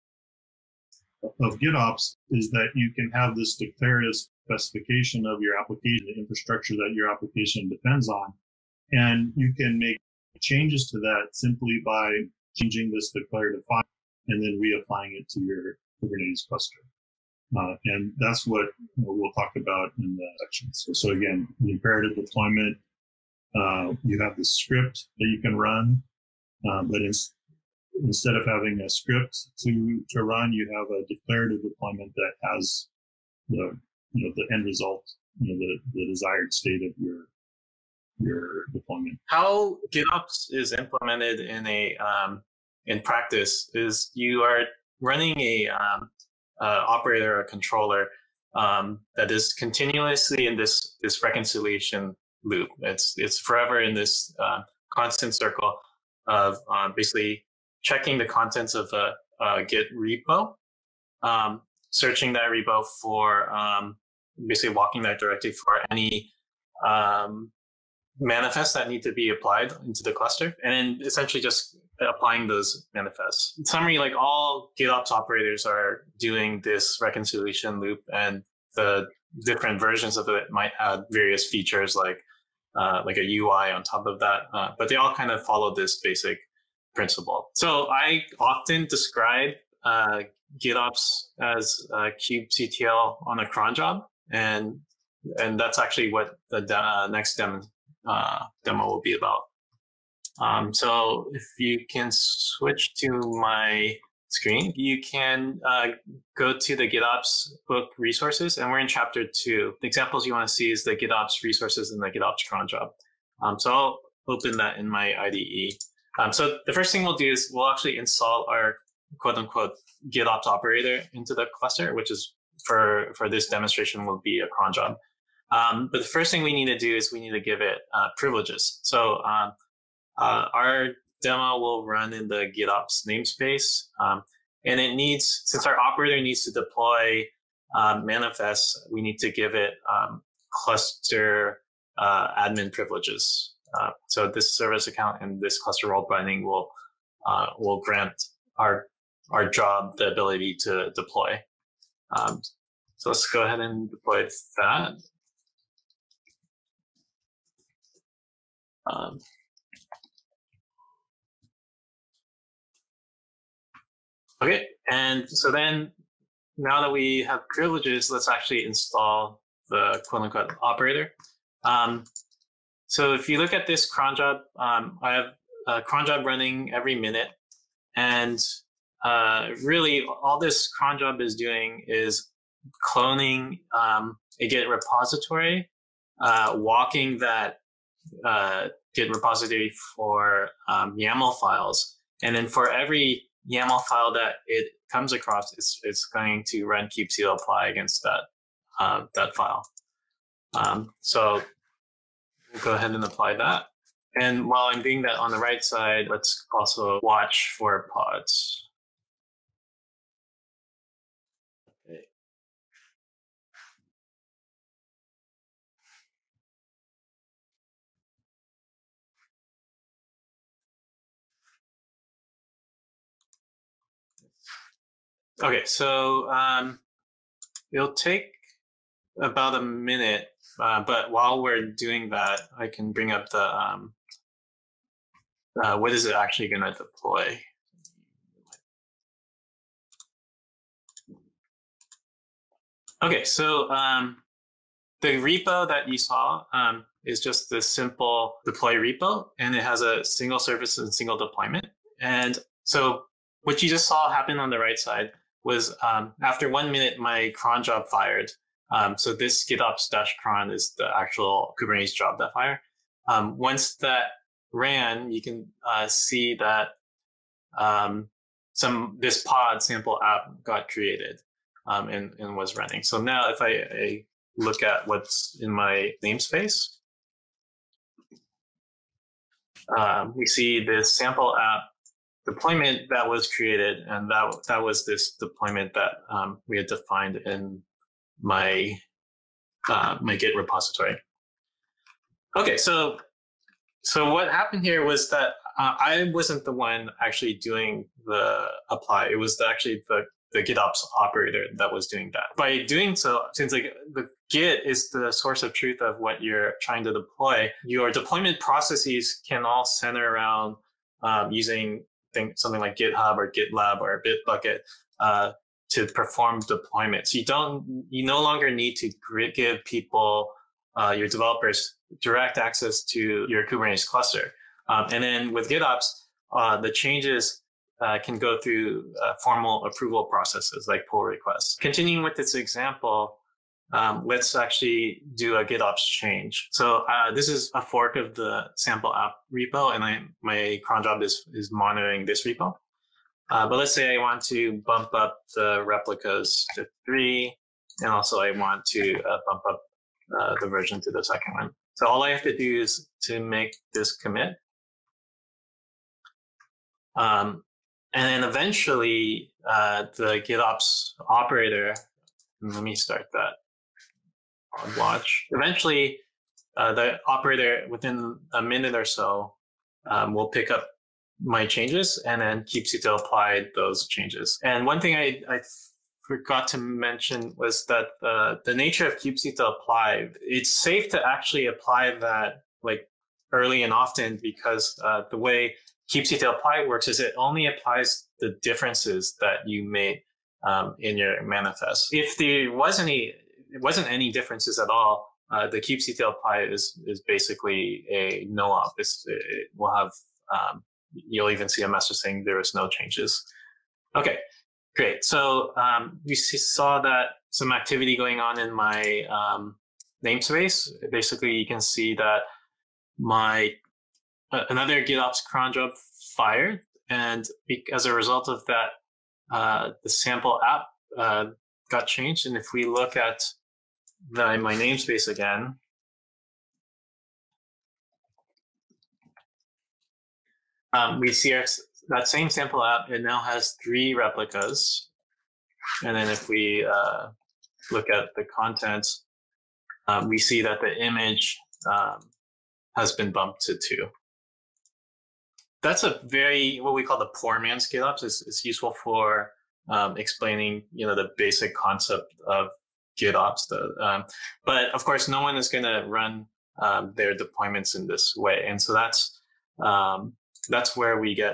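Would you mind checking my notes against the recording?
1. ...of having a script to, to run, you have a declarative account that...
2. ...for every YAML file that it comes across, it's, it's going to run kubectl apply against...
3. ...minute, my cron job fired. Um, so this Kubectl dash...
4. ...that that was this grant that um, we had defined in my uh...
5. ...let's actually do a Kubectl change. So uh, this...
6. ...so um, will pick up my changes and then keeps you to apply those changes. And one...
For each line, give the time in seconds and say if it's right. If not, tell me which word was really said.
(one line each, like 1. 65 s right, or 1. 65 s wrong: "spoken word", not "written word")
1. 28 s wrong: "deployment", not "account"
2. 192 s right
3. 256 s wrong: "GitOps", not "Kubectl"
4. 284 s wrong: "deployment", not "grant"
5. 334 s wrong: "GitOps", not "Kubectl"
6. 368 s right.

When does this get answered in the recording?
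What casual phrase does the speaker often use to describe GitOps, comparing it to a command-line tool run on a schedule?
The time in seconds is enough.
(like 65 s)
92 s.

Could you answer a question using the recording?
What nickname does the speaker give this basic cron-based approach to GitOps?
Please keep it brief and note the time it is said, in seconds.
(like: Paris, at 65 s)
poor man scale ups, at 447 s.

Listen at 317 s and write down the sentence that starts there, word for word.
You don't, you no longer need to give people, uh, your developers direct access to your Kubernetes cluster.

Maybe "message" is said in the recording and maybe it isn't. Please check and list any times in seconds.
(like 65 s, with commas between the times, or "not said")
401 s.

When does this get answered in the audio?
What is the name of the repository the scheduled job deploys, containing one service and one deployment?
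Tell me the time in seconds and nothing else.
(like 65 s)
247 s.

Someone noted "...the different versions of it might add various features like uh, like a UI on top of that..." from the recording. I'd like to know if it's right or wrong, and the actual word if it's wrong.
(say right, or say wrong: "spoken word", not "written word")
right.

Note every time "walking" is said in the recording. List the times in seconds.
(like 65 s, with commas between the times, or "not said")
64 s, 186 s.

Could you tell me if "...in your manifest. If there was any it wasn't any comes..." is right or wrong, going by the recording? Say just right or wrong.
wrong.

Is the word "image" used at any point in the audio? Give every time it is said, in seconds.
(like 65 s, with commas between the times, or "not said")
440 s.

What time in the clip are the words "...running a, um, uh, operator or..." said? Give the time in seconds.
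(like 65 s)
44 s.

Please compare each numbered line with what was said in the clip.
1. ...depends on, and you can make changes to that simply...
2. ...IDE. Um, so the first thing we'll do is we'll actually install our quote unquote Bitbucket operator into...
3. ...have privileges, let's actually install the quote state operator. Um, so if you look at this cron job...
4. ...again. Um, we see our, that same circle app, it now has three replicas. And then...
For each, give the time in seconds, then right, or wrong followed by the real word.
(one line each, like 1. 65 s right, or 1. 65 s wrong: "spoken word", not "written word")
1. 7 s right
2. 115 s wrong: "GitOps", not "Bitbucket"
3. 167 s wrong: "unquote", not "state"
4. 425 s wrong: "sample", not "circle".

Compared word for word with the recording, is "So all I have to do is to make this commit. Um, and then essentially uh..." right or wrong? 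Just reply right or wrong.
wrong.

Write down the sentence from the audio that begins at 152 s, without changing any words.
Um, so let's go ahead and deploy that.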